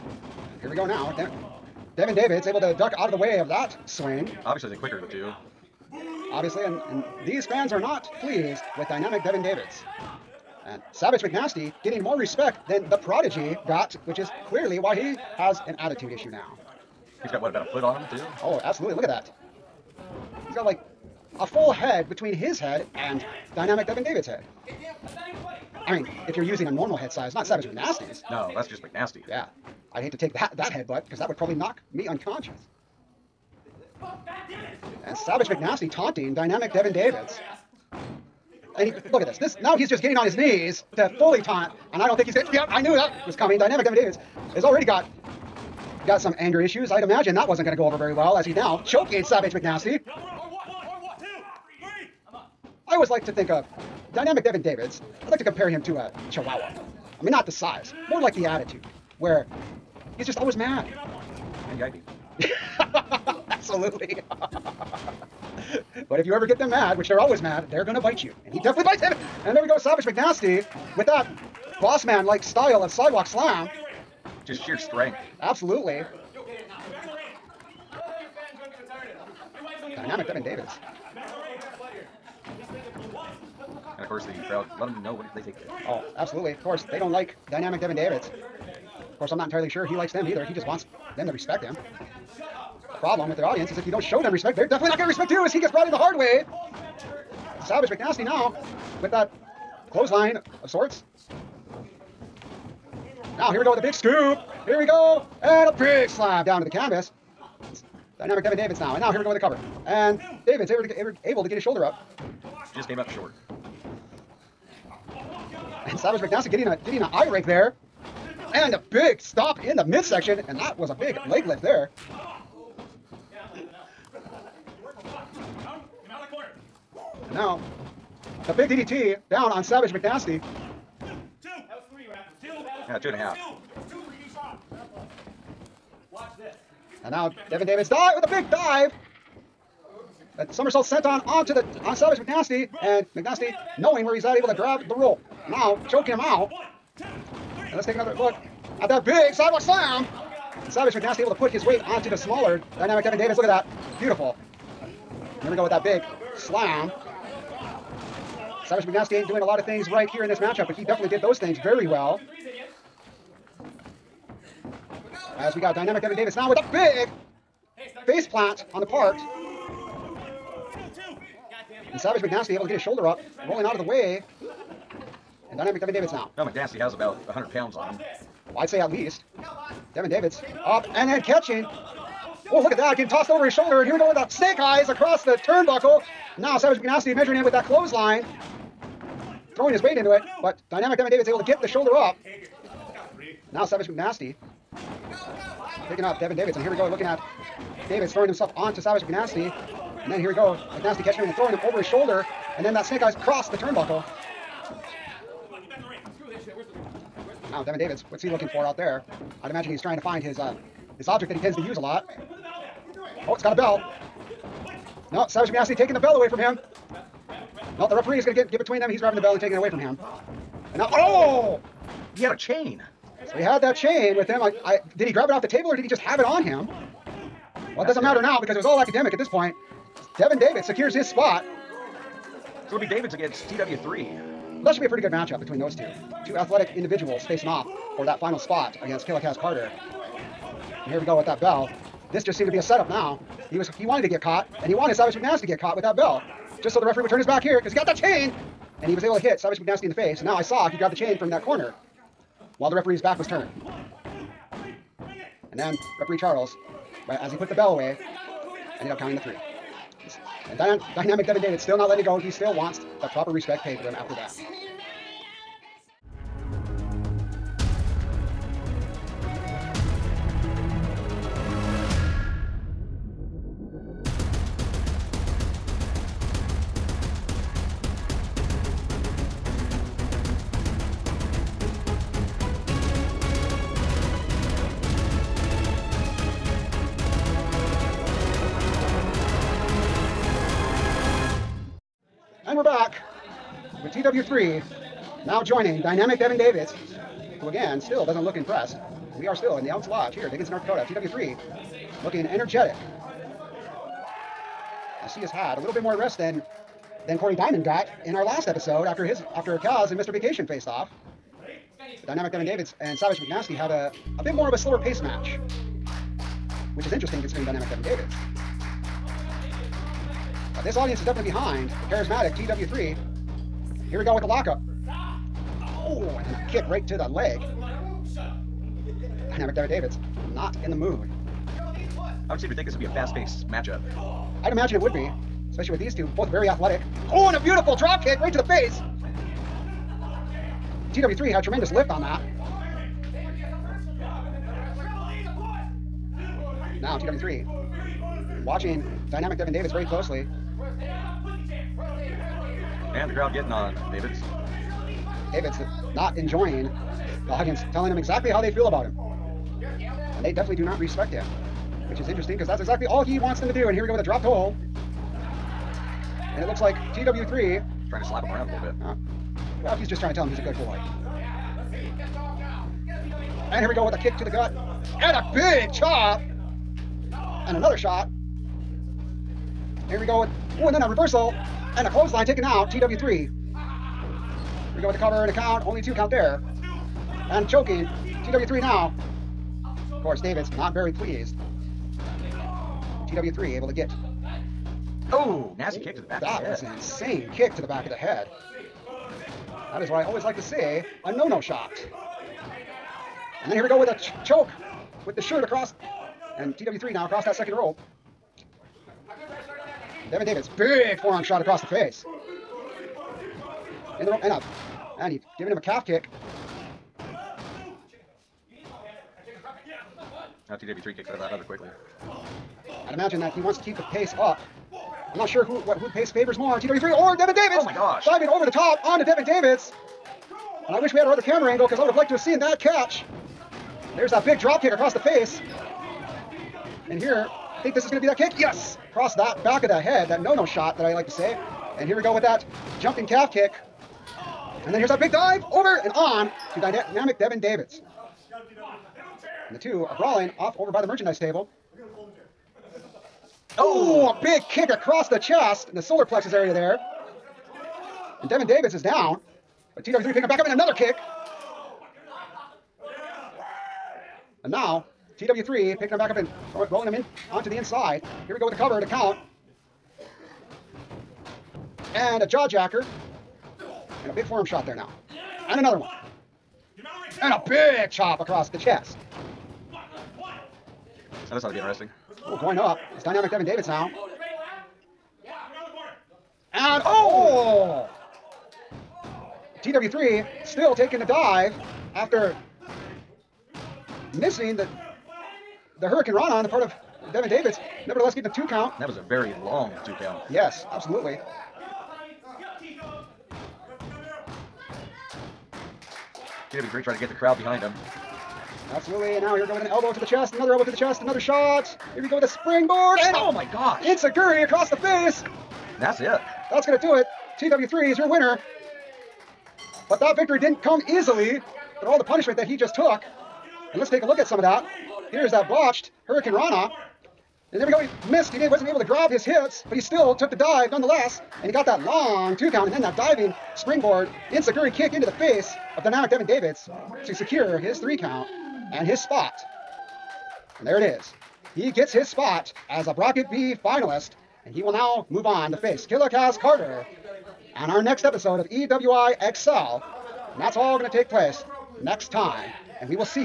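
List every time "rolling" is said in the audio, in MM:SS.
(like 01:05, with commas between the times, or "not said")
02:53, 07:46.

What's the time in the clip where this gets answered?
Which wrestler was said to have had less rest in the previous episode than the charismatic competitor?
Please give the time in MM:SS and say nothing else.
05:07.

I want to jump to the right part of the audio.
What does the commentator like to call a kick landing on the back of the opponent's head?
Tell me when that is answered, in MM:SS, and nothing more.
06:41.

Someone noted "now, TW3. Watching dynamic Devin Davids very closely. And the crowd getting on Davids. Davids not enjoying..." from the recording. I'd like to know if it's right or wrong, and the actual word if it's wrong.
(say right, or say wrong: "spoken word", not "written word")
right.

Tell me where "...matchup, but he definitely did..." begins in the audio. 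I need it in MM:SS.
02:40.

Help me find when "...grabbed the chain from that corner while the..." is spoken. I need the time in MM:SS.
04:10.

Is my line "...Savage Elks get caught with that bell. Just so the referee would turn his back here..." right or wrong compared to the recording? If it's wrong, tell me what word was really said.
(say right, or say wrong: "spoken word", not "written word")
wrong: "McNasty", not "Elks".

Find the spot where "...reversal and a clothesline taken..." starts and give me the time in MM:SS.
06:20.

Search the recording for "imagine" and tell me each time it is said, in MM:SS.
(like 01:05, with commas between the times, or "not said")
00:47, 03:29, 05:34, 07:02.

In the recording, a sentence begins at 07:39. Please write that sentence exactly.
But TW3 picking him back up in another kick.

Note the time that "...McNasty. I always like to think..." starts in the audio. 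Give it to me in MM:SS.
00:49.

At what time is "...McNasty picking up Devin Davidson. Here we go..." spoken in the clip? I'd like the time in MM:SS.
03:13.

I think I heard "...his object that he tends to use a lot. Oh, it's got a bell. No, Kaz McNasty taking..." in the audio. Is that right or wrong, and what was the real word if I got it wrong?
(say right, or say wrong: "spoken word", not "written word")
wrong: "Savage", not "Kaz".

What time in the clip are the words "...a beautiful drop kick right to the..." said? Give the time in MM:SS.
05:37.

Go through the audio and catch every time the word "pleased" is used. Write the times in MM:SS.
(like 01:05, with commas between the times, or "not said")
00:08, 06:30.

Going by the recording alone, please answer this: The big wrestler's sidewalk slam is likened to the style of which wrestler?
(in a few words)
Boss Man.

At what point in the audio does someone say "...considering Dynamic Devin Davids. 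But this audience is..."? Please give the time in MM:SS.
05:17.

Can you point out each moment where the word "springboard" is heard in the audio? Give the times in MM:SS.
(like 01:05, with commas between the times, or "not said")
08:32, 08:53.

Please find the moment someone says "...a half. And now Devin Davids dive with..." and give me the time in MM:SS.
02:13.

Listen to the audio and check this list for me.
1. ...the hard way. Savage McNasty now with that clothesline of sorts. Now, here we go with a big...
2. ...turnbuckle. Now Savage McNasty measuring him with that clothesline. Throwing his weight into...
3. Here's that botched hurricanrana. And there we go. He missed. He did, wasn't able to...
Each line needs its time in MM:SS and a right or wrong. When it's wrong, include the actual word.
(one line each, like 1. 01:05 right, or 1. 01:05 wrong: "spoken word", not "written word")
1. 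01:35 right
2. 03:05 right
3. 08:45 right.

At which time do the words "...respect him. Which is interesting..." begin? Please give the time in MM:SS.
06:00.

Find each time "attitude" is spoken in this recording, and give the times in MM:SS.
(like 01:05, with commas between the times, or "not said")
00:15, 00:58.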